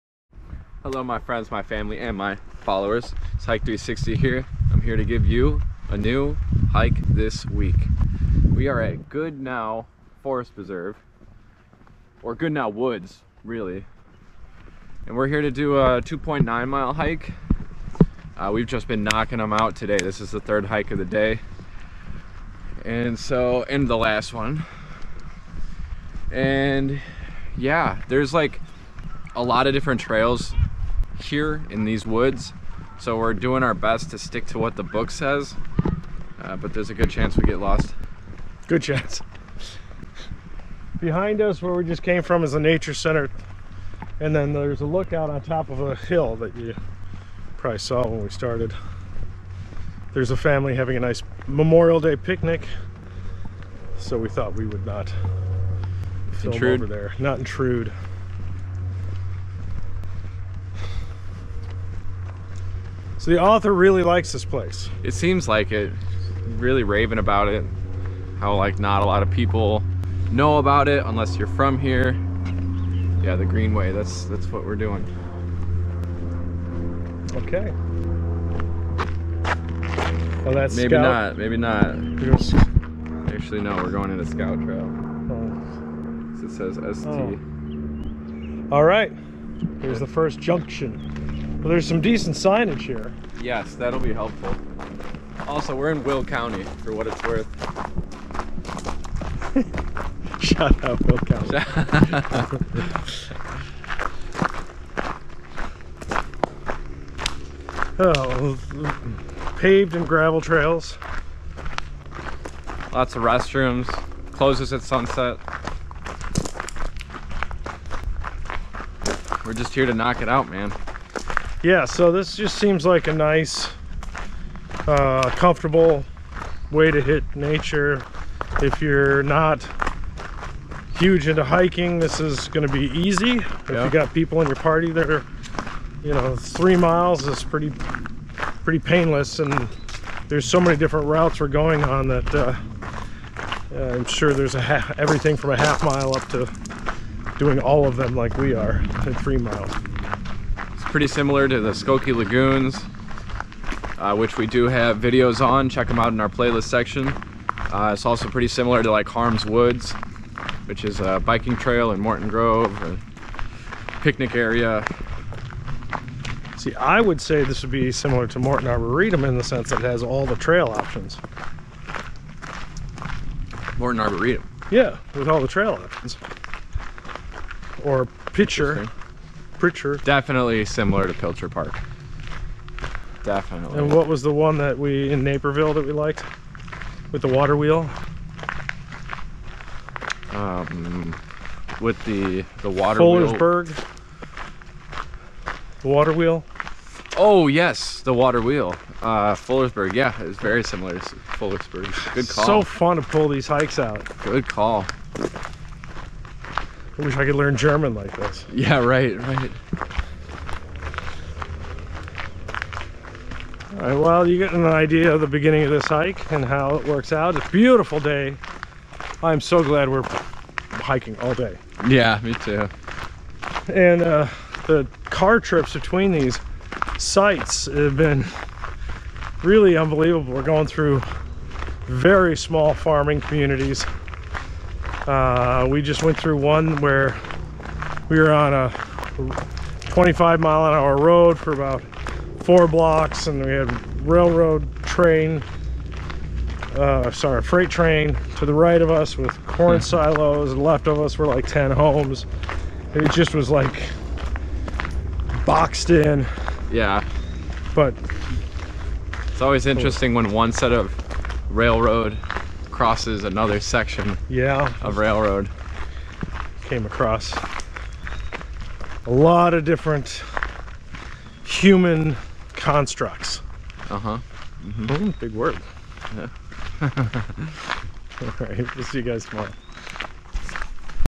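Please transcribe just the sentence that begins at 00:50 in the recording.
There's a family having a nice Memorial Day picnic.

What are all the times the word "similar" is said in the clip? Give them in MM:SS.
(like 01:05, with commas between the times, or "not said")
02:31, 02:38, 02:47, 03:00, 03:20.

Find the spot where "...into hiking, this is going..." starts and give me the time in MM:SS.
02:11.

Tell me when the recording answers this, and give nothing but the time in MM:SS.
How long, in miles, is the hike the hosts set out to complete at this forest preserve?
00:16.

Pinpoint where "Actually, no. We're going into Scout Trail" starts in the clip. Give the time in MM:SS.
01:23.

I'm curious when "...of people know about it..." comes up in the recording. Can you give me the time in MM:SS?
01:09.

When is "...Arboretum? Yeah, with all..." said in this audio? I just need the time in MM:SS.
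02:54.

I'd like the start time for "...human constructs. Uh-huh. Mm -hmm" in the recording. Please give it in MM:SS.
04:31.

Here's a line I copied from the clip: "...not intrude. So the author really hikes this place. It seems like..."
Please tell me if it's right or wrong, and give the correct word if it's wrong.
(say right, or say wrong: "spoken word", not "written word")
wrong: "likes", not "hikes".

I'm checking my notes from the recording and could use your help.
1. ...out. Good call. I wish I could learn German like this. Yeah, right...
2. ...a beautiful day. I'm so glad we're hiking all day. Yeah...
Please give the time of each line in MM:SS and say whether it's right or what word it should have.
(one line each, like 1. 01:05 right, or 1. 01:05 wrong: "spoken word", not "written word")
1. 03:23 right
2. 03:37 right.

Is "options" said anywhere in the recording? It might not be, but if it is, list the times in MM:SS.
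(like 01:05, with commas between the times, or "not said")
02:50, 02:55.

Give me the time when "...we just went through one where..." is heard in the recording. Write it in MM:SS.
03:55.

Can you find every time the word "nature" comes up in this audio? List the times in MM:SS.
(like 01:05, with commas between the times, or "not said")
00:42, 02:07.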